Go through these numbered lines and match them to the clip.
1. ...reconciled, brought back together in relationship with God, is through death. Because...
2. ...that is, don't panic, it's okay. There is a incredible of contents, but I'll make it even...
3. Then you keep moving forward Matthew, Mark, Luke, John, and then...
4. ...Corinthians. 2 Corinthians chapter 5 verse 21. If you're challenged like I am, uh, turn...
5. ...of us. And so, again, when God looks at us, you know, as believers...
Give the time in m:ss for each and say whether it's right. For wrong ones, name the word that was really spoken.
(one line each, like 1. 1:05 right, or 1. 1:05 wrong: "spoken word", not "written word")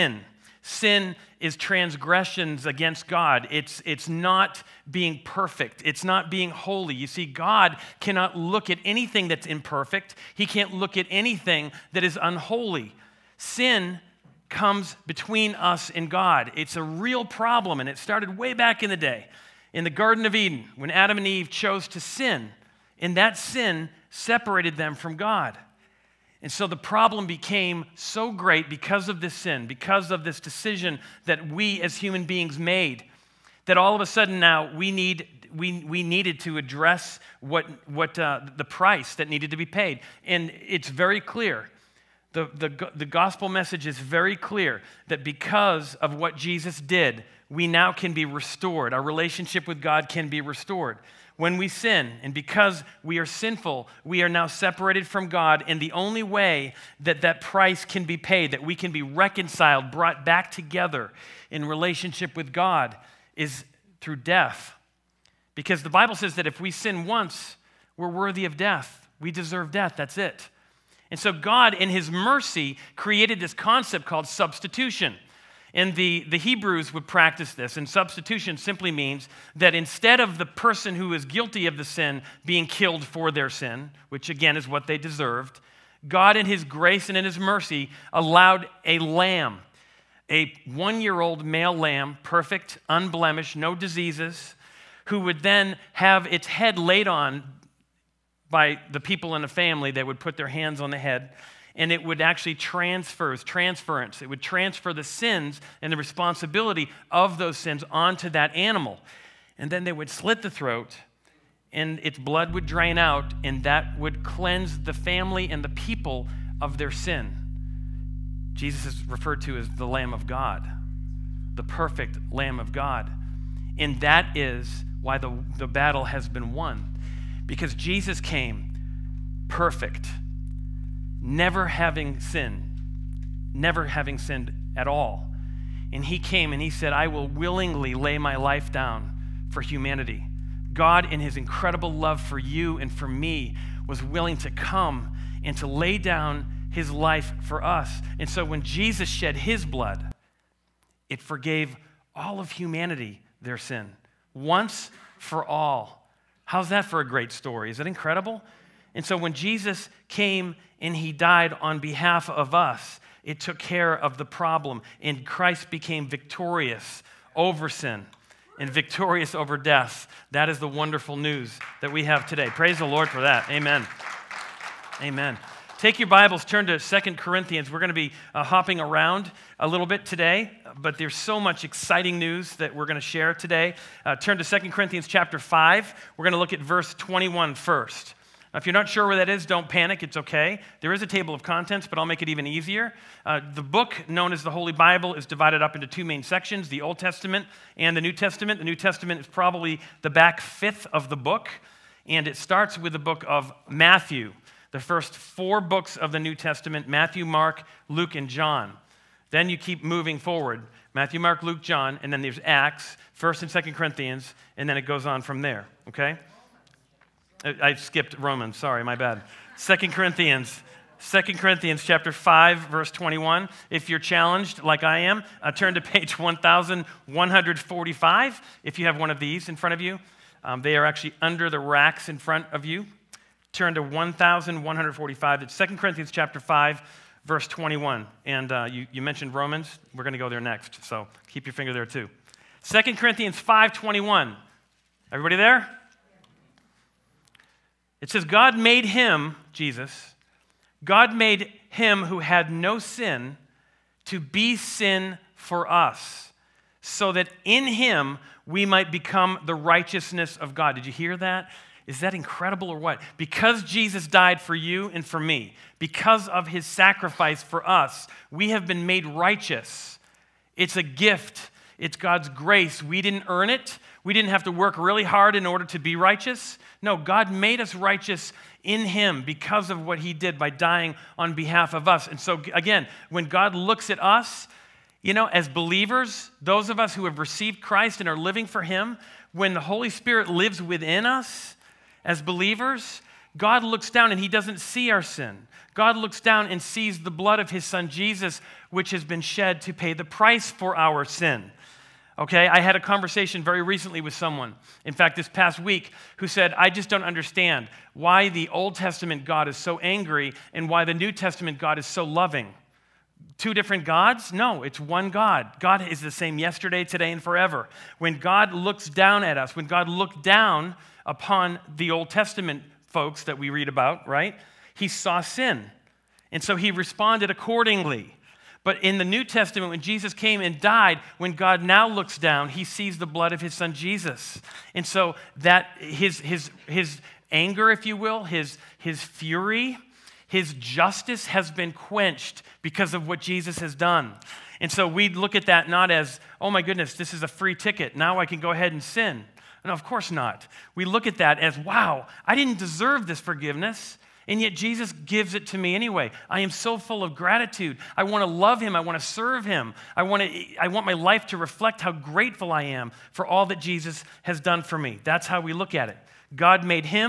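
1. 0:59 right
2. 3:09 wrong: "table", not "incredible"
3. 3:29 right
4. 3:39 right
5. 4:41 right.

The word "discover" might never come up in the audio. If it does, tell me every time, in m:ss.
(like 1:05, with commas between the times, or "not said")
not said.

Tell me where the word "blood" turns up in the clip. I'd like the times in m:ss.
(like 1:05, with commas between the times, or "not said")
1:52, 2:29, 4:57, 5:33.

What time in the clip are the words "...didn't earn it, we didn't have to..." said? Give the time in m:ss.
4:33.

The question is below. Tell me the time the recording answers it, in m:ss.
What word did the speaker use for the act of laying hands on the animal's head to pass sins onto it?
1:43.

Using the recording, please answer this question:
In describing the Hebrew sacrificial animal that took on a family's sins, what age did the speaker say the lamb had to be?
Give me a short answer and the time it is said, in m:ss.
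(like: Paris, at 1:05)
1 year old, at 1:30.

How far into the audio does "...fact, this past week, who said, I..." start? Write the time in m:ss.
5:04.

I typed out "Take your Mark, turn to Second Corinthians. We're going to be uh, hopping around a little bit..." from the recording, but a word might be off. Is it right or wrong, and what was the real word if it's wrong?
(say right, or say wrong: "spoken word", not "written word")
wrong: "Bibles", not "Mark".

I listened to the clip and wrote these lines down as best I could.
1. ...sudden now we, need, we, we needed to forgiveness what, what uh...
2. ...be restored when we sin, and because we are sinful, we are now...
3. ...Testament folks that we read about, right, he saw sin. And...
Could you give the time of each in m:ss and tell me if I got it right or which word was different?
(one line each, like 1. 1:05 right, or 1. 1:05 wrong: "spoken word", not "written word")
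1. 0:34 wrong: "address", not "forgiveness"
2. 0:50 right
3. 5:22 right.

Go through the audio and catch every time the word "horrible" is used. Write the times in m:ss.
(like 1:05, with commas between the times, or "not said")
not said.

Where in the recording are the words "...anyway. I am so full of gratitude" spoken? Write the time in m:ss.
5:55.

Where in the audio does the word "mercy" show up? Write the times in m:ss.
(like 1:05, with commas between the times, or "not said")
1:12, 1:27.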